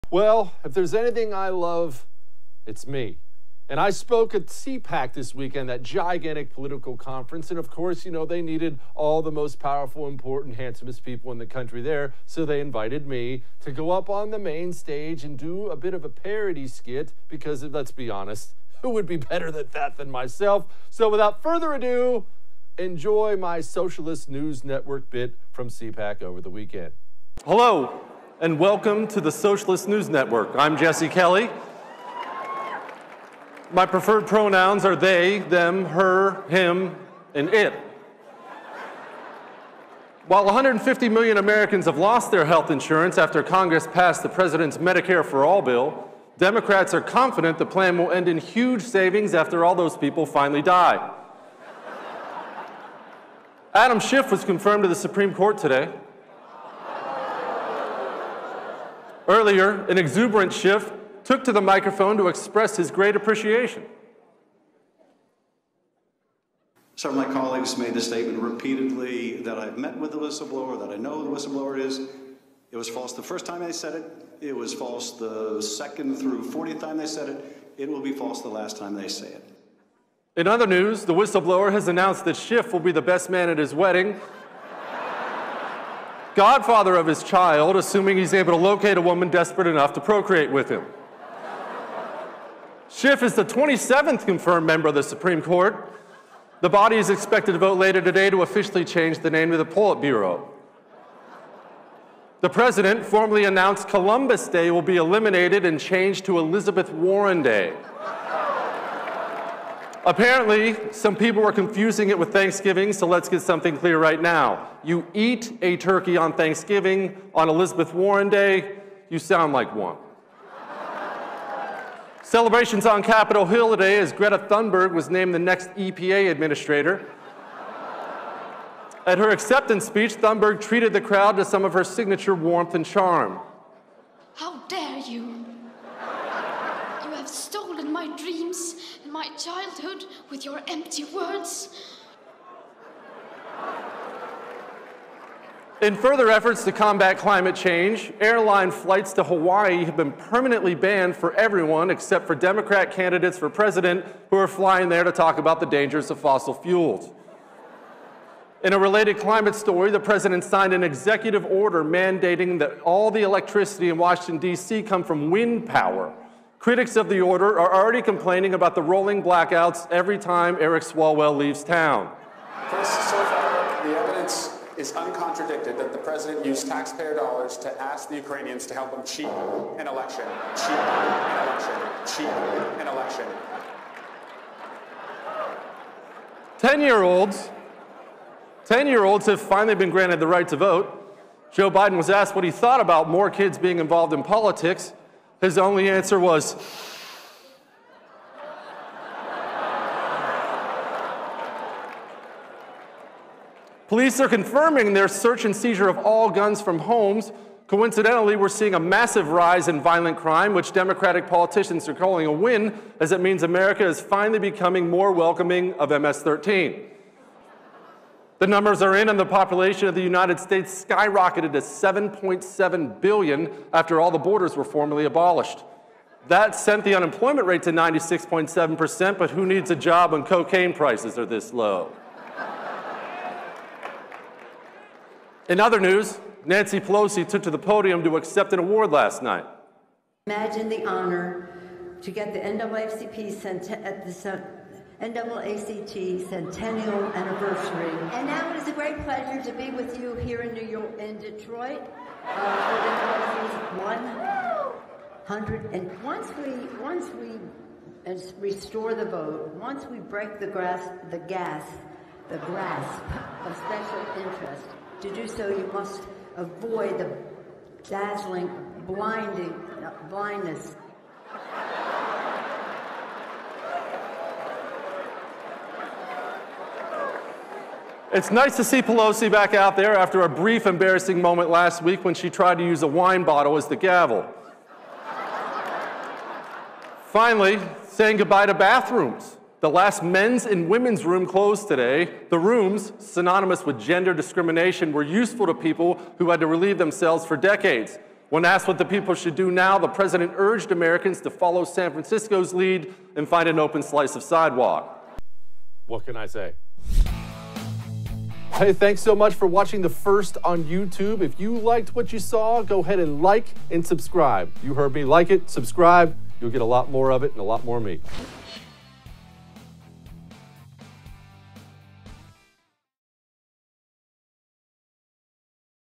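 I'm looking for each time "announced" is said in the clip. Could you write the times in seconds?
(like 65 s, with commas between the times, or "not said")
81 s, 103 s.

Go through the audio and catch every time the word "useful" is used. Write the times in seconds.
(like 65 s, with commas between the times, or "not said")
295 s.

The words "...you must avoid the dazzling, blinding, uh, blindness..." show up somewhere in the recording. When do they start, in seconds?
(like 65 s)
265 s.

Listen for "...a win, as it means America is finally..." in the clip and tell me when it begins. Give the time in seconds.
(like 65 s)
212 s.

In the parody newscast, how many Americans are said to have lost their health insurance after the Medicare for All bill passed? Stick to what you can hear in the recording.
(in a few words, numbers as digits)
150 million.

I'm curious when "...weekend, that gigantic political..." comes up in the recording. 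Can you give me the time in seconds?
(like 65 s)
5 s.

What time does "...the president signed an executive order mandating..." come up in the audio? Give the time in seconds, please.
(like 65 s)
159 s.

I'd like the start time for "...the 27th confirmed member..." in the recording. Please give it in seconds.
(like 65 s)
93 s.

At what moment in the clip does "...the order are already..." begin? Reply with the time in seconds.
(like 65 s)
167 s.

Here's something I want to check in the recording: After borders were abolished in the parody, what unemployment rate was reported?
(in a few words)
96.7%.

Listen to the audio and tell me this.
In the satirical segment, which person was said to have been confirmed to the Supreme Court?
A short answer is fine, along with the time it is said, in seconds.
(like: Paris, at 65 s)
Adam Schiff, at 53 s.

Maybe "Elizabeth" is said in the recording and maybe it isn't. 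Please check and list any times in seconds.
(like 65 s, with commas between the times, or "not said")
106 s, 117 s.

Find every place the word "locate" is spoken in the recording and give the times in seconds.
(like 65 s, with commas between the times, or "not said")
88 s.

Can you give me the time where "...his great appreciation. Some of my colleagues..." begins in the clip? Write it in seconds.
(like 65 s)
62 s.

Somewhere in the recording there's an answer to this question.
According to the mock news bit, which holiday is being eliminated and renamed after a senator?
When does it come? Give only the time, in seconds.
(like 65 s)
103 s.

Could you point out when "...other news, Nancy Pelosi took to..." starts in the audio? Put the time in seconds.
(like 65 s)
235 s.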